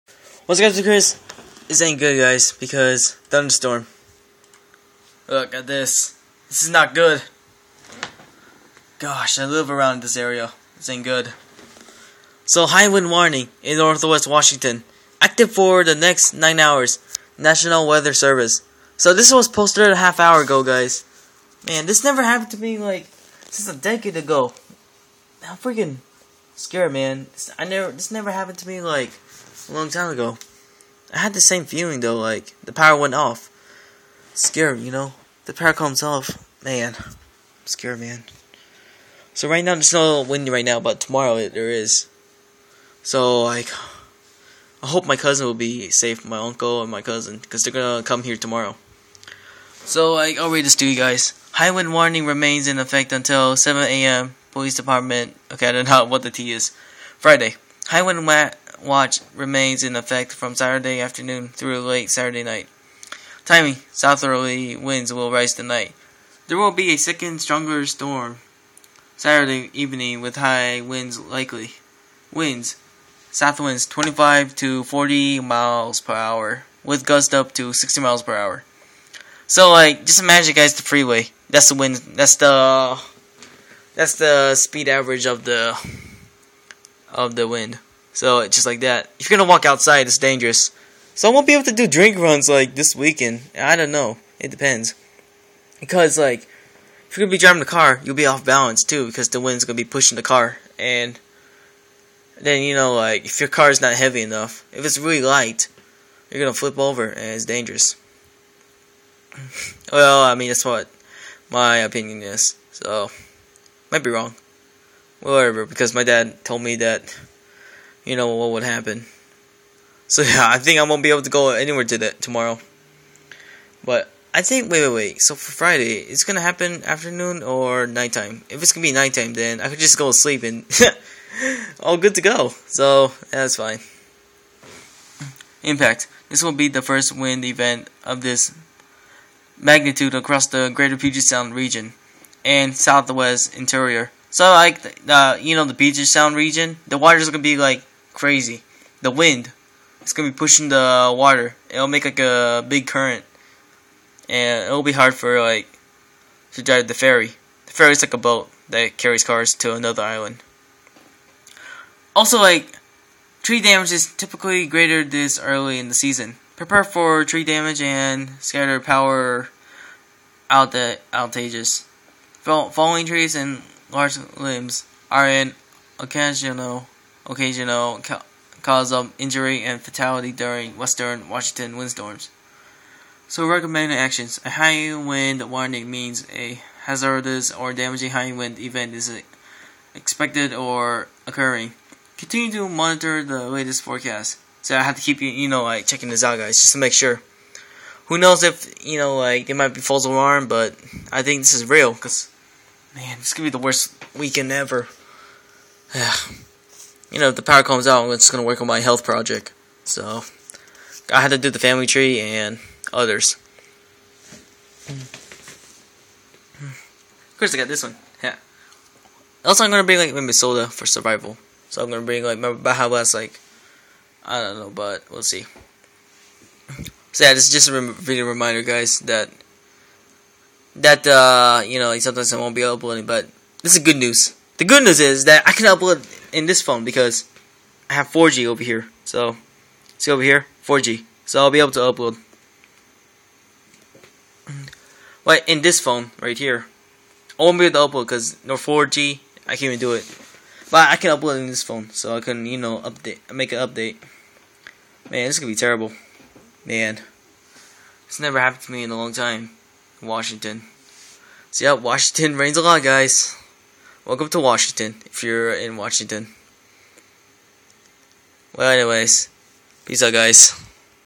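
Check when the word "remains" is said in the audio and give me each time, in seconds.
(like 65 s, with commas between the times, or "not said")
52 s, 59 s.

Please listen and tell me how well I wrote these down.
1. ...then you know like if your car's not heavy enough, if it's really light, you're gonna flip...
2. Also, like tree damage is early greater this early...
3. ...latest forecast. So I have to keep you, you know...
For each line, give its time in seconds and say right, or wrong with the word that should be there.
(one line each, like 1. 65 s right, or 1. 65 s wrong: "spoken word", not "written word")
1. 102 s right
2. 162 s wrong: "typically", not "early"
3. 193 s right.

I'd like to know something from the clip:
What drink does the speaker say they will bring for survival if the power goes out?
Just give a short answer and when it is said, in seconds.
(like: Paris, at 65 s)
Baja Blast, at 222 s.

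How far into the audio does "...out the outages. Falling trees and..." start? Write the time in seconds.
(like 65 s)
170 s.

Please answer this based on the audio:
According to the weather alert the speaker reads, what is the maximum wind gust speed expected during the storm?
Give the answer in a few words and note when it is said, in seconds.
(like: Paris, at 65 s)
60 miles per hour, at 77 s.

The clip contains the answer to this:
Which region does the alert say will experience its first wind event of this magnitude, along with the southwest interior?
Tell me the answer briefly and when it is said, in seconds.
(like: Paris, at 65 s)
Greater Puget Sound, at 140 s.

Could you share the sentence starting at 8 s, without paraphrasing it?
Gosh, I live around this area.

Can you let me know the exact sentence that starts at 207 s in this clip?
you know, if the power comes out, I'm just gonna work on my health project.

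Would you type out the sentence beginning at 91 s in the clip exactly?
So I won't be able to do drink runs like this weekend.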